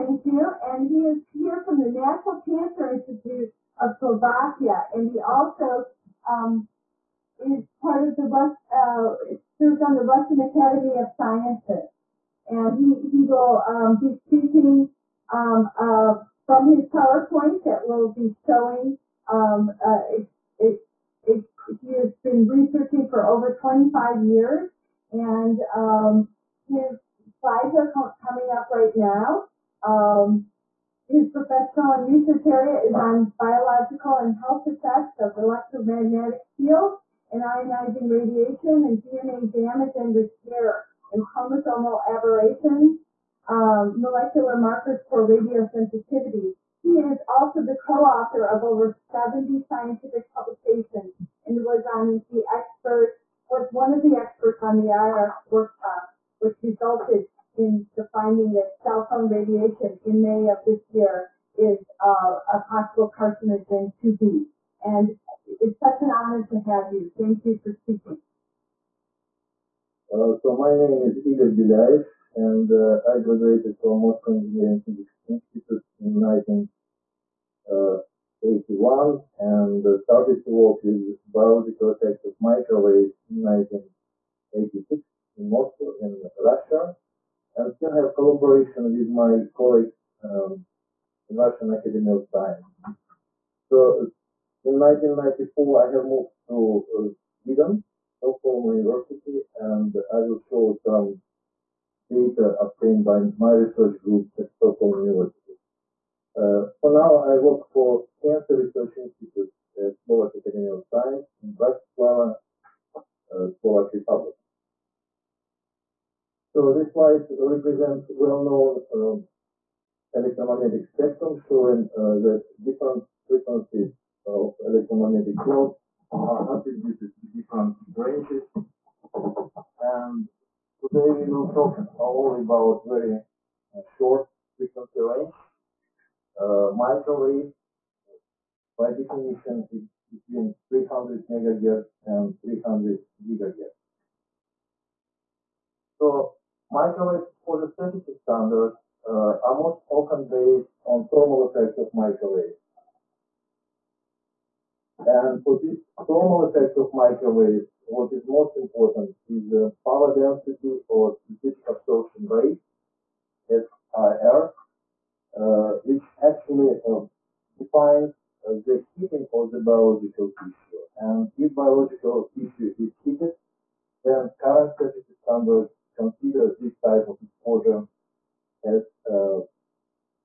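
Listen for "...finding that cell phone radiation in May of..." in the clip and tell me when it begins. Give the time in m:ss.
0:58.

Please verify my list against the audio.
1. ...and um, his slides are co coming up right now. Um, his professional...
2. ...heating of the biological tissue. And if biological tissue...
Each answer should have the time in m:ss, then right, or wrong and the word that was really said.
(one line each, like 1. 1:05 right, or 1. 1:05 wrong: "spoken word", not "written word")
1. 0:25 right
2. 2:48 right.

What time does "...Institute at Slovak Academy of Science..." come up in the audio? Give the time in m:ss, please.
1:48.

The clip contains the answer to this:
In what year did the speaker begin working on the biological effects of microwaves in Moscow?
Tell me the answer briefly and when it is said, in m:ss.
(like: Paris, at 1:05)
1986, at 1:23.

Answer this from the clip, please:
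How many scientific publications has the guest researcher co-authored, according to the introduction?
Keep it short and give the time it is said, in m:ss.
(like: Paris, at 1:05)
over 70, at 0:48.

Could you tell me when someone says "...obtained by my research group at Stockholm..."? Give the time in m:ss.
1:42.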